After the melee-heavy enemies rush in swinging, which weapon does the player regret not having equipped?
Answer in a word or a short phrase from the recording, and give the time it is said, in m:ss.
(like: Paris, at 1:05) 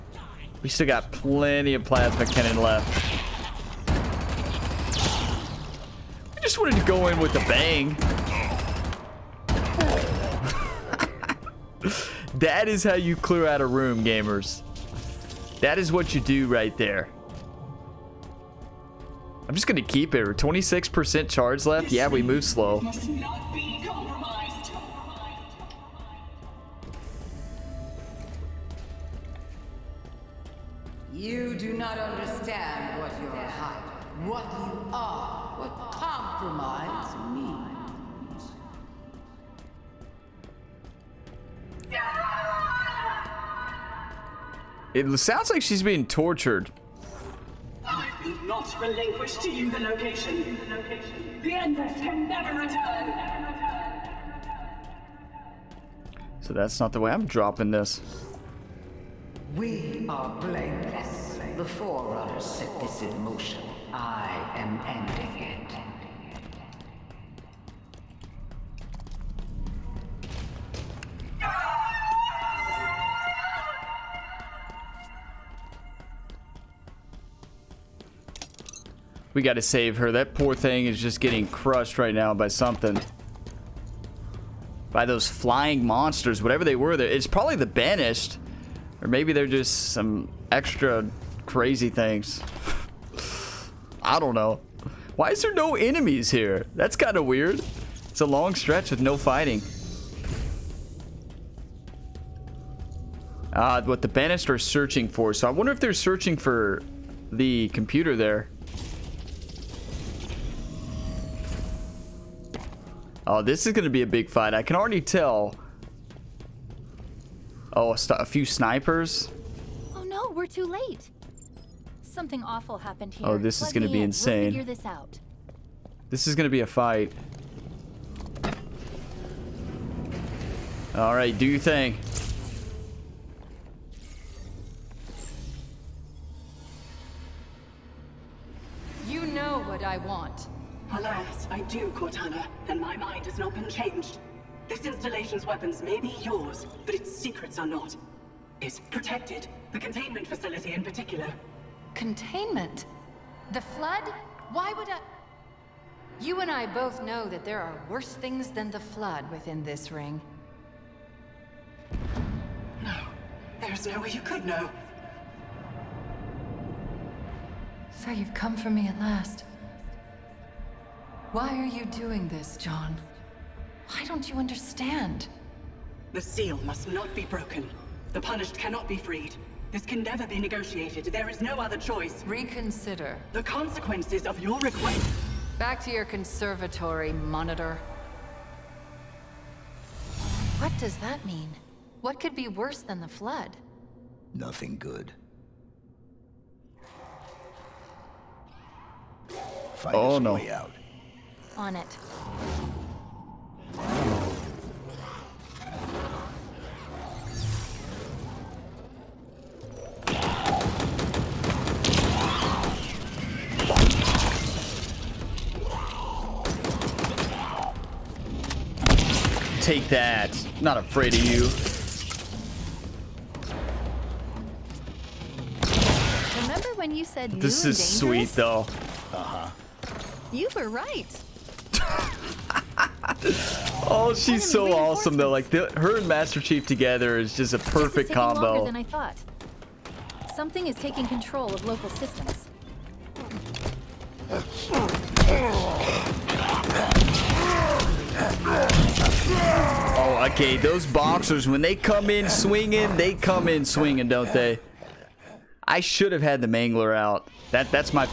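The Mangler, at 4:16.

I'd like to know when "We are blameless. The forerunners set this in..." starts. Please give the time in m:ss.
0:59.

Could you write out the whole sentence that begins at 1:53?
Oh, this is going to be a big fight.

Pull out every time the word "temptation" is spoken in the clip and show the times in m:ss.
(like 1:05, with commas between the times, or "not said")
not said.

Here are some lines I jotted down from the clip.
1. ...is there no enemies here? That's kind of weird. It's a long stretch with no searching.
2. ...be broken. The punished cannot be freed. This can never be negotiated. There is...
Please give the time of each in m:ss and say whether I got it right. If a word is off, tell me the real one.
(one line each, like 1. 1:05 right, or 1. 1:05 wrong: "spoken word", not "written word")
1. 1:35 wrong: "fighting", not "searching"
2. 2:57 right.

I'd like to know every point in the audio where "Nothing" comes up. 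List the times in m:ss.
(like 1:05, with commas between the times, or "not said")
3:14.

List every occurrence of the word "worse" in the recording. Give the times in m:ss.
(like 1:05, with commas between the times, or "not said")
2:37, 3:12.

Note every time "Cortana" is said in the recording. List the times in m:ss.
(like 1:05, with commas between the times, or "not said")
2:21.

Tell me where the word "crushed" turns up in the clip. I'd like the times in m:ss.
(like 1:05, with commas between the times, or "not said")
1:21.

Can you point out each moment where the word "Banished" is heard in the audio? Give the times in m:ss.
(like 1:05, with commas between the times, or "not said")
1:27, 1:44.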